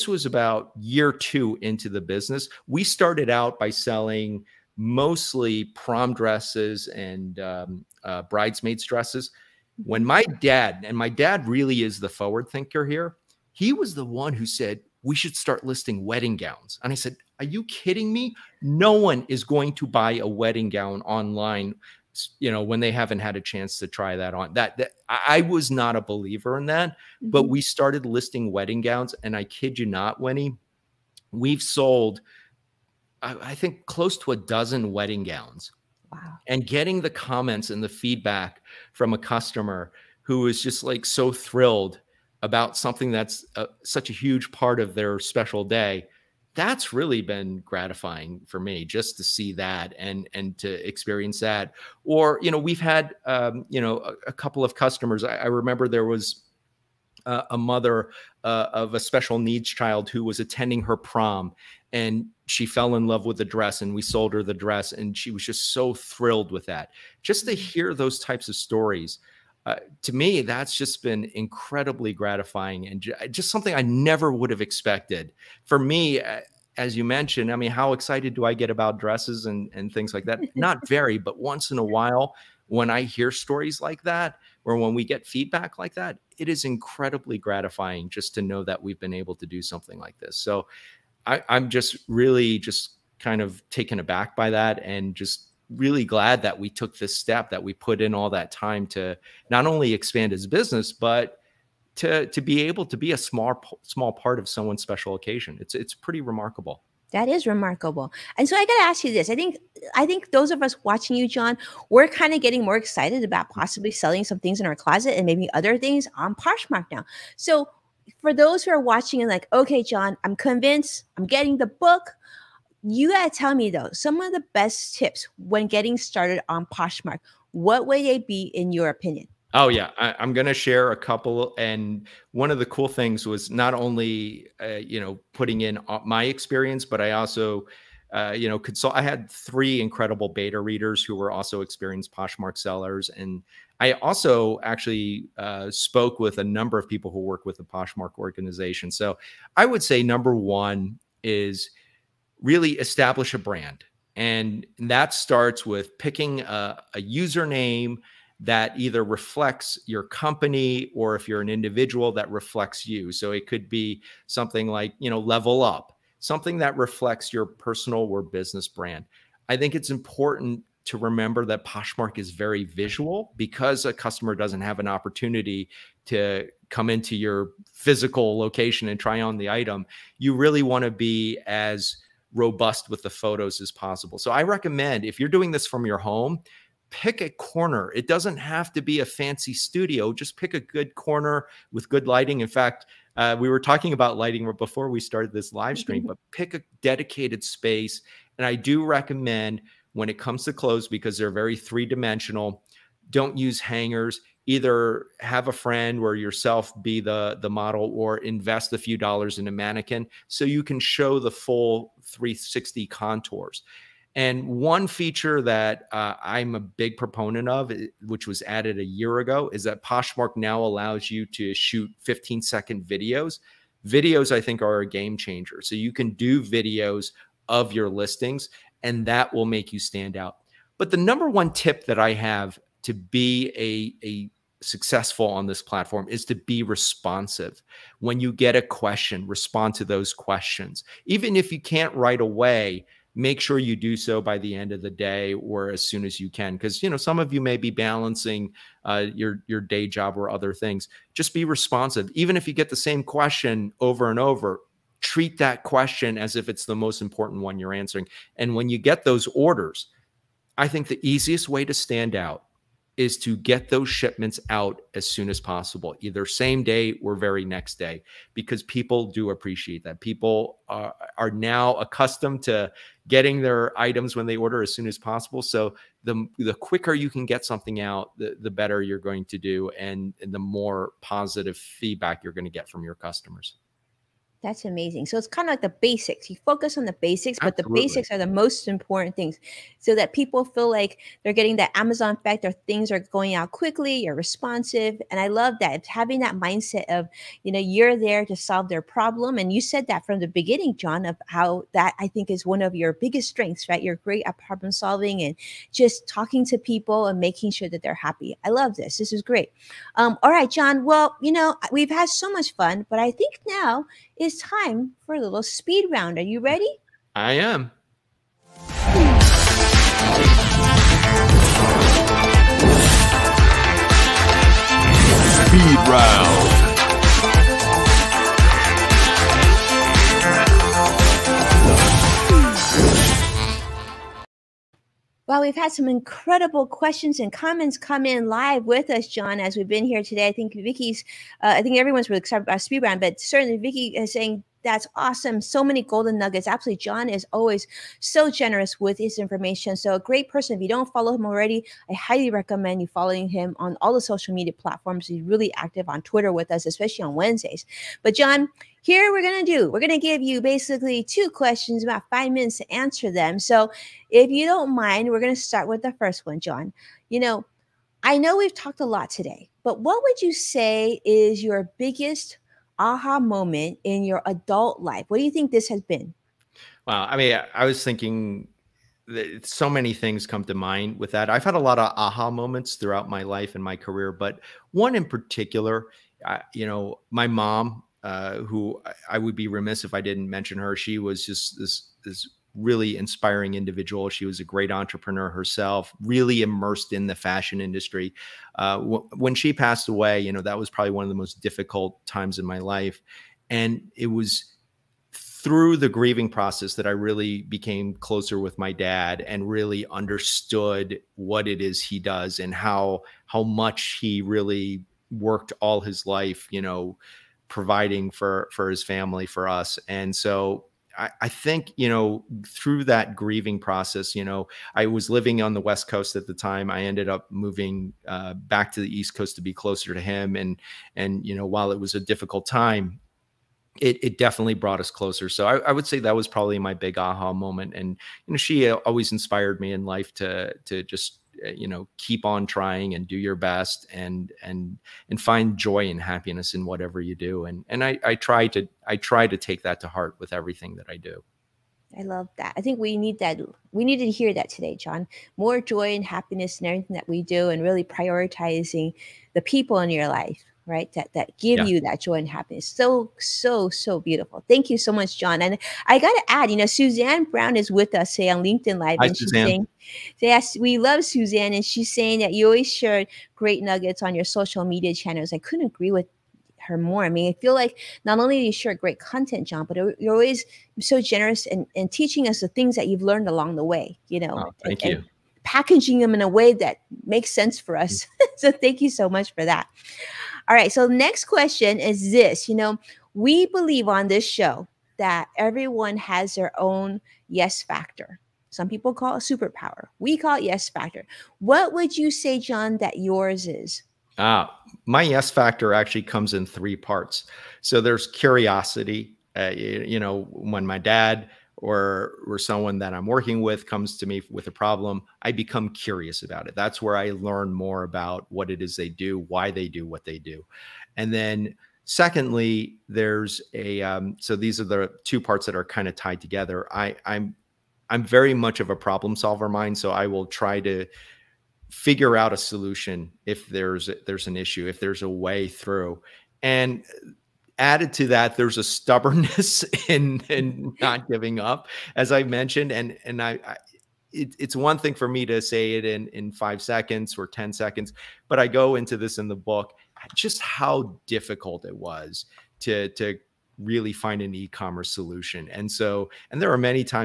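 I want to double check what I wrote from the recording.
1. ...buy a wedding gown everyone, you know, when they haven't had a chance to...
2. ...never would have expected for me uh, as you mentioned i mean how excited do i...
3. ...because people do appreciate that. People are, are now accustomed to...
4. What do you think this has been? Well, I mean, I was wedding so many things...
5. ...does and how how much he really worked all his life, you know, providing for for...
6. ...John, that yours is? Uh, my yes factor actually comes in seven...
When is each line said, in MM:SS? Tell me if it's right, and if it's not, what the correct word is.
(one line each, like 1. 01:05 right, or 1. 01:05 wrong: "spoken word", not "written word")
1. 00:19 wrong: "online", not "everyone"
2. 01:13 right
3. 04:28 right
4. 06:15 wrong: "thinking", not "wedding"
5. 06:52 right
6. 08:22 wrong: "three", not "seven".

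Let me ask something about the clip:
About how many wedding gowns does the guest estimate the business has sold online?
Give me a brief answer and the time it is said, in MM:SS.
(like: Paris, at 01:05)
Close to a dozen, at 00:33.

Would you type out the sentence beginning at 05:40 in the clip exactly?
I think Vicky's, uh, I think everyone's really excited about speed round, but certainly Vicky is saying, that's awesome.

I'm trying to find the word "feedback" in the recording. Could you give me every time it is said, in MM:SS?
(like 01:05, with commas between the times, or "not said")
00:37, 01:25, 04:41.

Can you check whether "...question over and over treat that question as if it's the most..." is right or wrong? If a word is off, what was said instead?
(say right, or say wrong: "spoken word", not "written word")
right.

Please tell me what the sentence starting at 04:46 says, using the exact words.
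You focus on the basics, Absolutely.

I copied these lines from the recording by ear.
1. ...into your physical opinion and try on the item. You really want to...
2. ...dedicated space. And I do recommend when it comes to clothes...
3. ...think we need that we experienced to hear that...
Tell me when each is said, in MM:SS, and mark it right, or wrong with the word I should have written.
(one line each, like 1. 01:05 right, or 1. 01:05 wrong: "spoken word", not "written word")
1. 02:56 wrong: "location", not "opinion"
2. 03:16 right
3. 07:32 wrong: "needed", not "experienced".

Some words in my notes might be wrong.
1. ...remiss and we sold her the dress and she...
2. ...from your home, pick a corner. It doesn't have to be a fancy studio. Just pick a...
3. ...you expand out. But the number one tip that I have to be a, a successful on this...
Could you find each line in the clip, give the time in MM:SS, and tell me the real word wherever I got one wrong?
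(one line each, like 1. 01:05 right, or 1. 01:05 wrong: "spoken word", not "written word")
1. 01:03 wrong: "dress", not "remiss"
2. 03:05 right
3. 03:49 wrong: "stand", not "expand".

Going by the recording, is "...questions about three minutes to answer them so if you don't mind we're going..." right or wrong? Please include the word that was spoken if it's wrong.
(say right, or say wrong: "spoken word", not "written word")
wrong: "five", not "three".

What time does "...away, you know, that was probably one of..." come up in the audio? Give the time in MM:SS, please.
06:39.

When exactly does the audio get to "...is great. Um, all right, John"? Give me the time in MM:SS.
05:09.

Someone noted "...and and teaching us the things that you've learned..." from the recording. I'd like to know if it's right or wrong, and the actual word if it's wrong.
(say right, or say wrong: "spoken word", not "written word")
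right.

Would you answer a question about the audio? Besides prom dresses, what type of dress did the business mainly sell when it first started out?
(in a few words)
Bridesmaids dresses.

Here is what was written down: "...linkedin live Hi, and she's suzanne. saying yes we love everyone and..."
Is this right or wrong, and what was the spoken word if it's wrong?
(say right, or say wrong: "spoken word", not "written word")
wrong: "suzanne", not "everyone".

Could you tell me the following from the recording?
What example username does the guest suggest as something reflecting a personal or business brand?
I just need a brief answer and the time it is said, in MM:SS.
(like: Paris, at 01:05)
Level up, at 02:45.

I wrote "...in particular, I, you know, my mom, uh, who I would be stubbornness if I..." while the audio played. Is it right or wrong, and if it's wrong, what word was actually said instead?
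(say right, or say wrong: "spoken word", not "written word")
wrong: "remiss", not "stubbornness".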